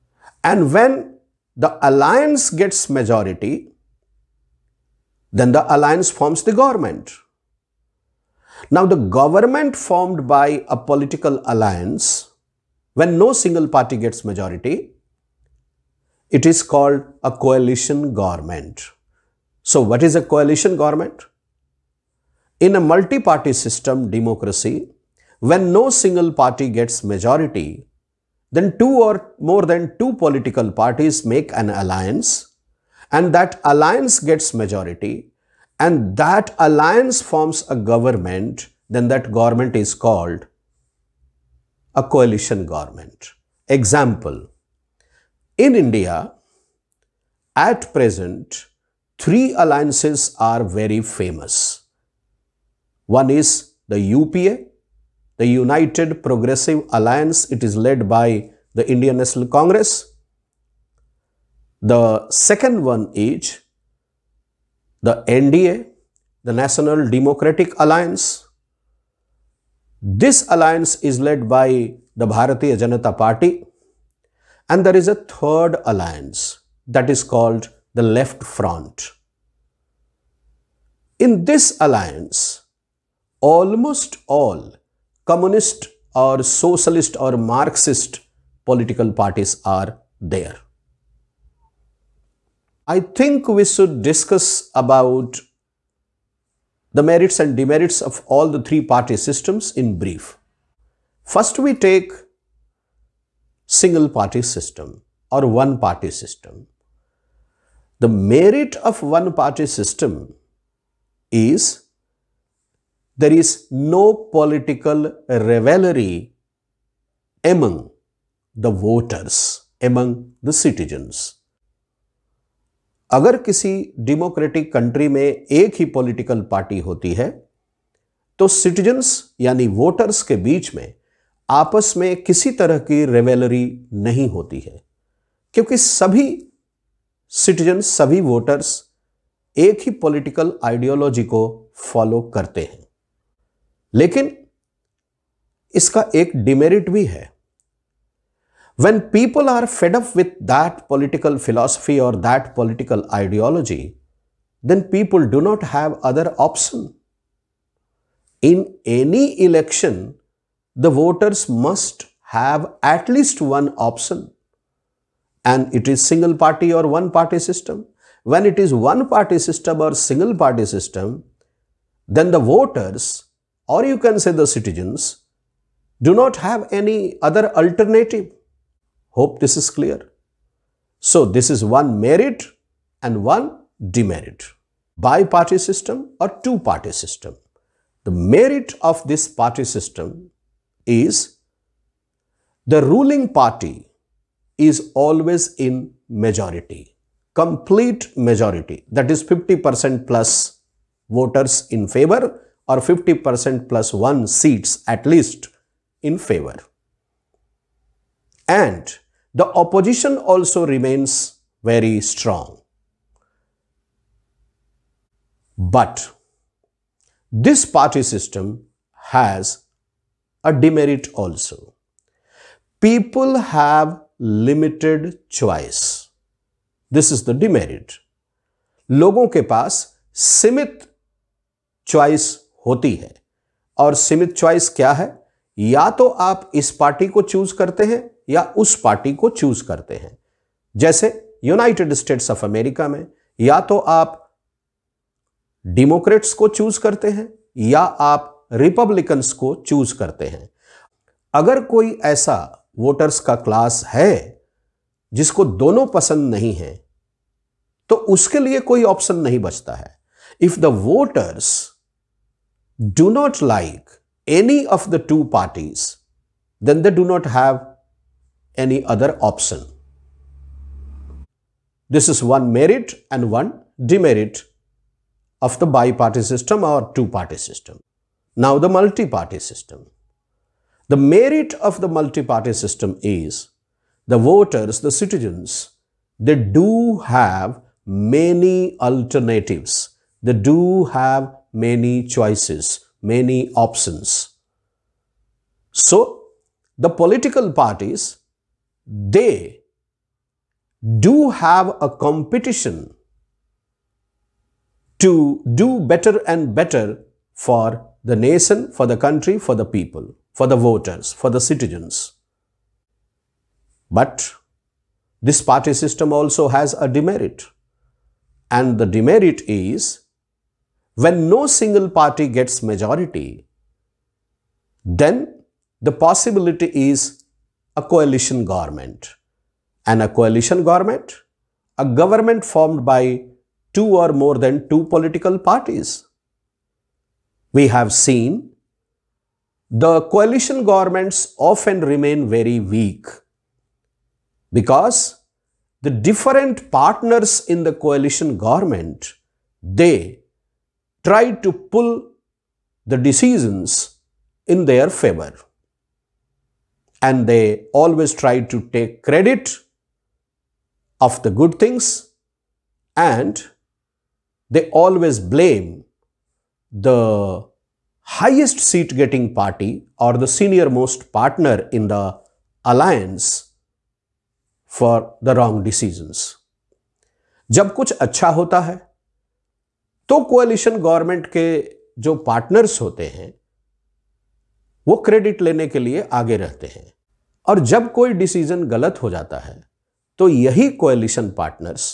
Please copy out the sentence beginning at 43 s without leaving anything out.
Example, in India, at present, three alliances are very famous.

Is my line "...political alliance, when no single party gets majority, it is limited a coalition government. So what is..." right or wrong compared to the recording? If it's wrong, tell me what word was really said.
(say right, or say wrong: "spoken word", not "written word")
wrong: "called", not "limited".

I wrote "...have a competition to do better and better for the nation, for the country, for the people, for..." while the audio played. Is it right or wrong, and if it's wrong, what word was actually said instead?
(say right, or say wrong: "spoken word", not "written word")
right.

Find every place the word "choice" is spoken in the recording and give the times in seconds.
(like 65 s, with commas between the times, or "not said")
225 s, 231 s, 292 s.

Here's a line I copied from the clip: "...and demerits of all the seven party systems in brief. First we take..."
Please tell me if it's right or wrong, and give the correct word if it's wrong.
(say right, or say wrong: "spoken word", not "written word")
wrong: "three", not "seven".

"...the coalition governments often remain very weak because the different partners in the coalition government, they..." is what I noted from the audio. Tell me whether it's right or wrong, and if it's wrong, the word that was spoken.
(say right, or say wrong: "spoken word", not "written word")
right.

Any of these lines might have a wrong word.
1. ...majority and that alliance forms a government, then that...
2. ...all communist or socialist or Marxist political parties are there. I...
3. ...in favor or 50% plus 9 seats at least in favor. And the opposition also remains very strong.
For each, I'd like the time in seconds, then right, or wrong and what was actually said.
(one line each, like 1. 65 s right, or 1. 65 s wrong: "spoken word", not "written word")
1. 34 s right
2. 84 s right
3. 201 s wrong: "1", not "9".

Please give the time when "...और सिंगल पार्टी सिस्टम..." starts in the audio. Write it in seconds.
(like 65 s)
169 s.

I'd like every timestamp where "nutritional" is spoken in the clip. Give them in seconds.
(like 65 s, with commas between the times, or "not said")
not said.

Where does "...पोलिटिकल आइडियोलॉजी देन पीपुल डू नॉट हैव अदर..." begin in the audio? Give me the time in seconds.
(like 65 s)
152 s.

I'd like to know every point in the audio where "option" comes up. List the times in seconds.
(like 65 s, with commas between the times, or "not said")
269 s, 293 s.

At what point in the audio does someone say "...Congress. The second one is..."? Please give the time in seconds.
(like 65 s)
59 s.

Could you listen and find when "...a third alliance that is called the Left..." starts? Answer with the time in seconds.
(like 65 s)
75 s.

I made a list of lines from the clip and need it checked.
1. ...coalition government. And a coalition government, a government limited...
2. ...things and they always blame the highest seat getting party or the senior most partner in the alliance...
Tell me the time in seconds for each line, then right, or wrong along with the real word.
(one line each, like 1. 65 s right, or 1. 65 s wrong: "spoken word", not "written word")
1. 327 s wrong: "formed", not "limited"
2. 361 s right.